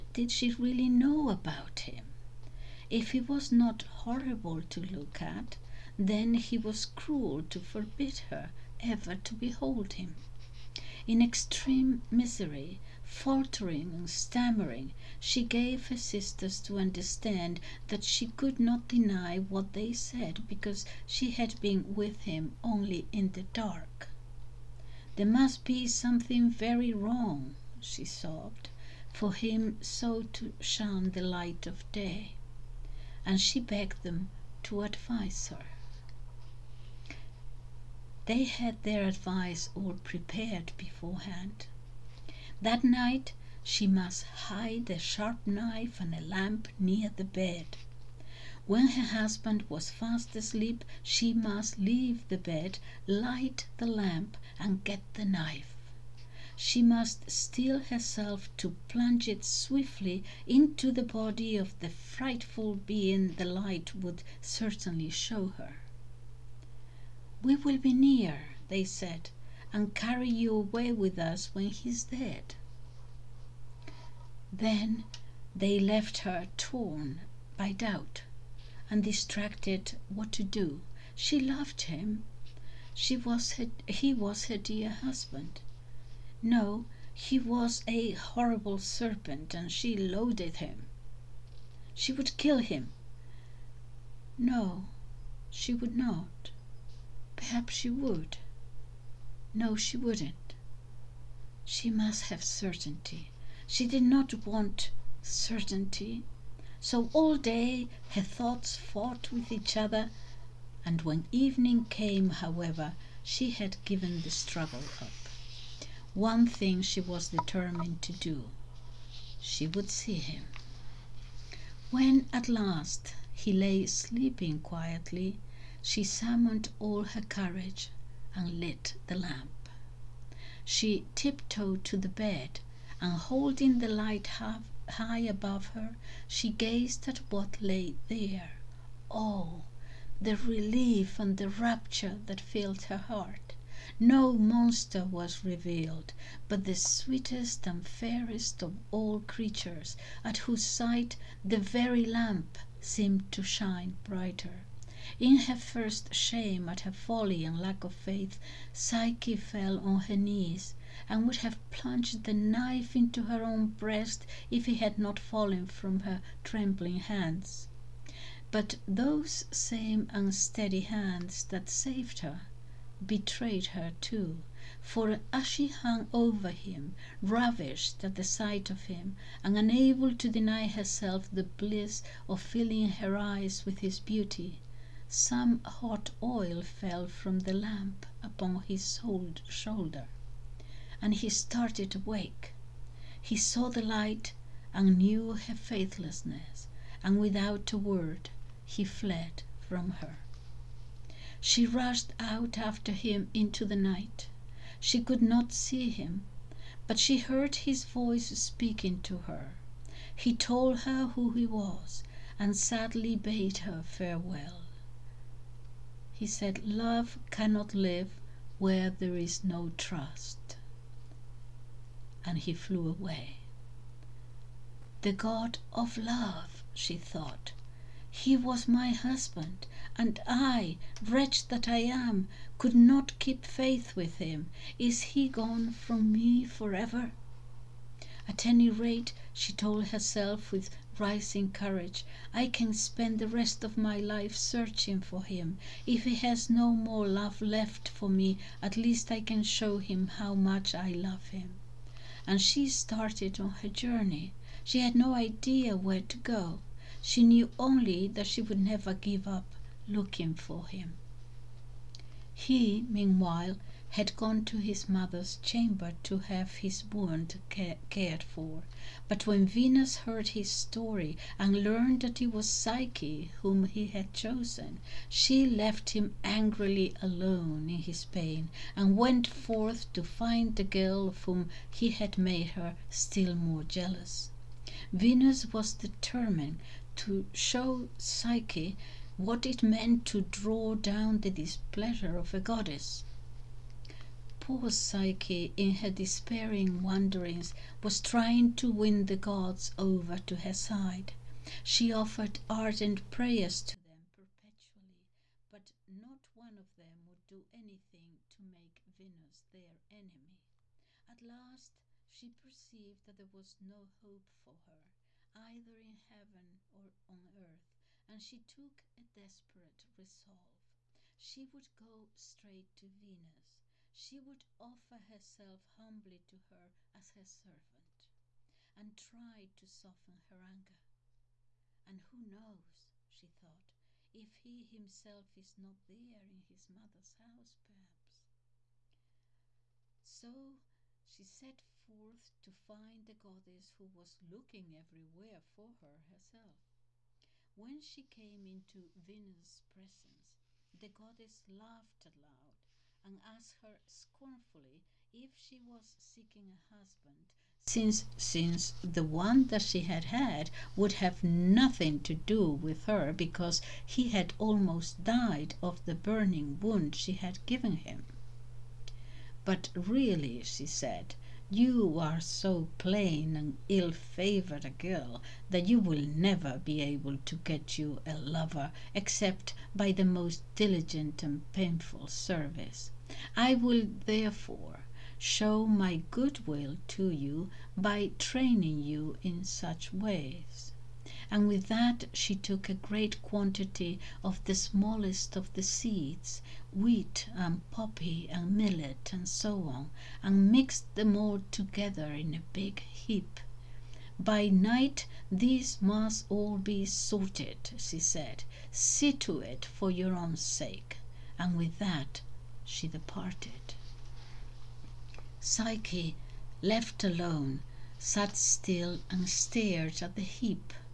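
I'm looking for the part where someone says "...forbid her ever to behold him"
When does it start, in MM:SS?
00:07.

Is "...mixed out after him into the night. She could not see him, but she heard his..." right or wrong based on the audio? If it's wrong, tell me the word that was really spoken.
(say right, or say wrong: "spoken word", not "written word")
wrong: "rushed", not "mixed".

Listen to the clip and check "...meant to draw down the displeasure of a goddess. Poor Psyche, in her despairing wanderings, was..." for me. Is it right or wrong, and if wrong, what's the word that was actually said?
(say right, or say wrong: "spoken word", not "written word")
right.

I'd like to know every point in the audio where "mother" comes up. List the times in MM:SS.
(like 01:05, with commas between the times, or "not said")
04:24, 05:36.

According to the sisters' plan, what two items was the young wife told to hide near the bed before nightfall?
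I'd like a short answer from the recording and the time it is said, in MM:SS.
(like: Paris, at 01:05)
a sharp knife and a lamp, at 00:44.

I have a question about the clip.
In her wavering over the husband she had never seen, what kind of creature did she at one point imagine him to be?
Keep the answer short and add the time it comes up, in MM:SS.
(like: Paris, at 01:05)
a horrible serpent, at 01:28.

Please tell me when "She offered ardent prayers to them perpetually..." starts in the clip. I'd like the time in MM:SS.
05:01.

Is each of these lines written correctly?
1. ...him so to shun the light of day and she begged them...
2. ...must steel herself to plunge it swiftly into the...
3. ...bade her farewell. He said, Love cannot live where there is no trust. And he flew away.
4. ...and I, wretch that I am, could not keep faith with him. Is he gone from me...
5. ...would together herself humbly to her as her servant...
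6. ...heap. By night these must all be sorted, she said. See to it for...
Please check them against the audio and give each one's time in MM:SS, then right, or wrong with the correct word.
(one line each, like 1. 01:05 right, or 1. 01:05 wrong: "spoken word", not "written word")
1. 00:29 right
2. 00:56 right
3. 03:33 right
4. 03:49 right
5. 05:24 wrong: "offer", not "together"
6. 06:42 right.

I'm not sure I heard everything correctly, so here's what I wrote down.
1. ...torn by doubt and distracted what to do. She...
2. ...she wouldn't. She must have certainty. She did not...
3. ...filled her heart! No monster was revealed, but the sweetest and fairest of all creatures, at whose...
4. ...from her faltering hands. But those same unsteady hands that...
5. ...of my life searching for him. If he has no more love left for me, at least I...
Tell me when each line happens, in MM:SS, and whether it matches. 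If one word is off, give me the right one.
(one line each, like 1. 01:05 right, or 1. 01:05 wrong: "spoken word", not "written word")
1. 01:16 right
2. 01:39 right
3. 02:22 right
4. 02:45 wrong: "trembling", not "faltering"
5. 04:03 right.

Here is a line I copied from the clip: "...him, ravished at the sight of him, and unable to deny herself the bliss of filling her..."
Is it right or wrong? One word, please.
right.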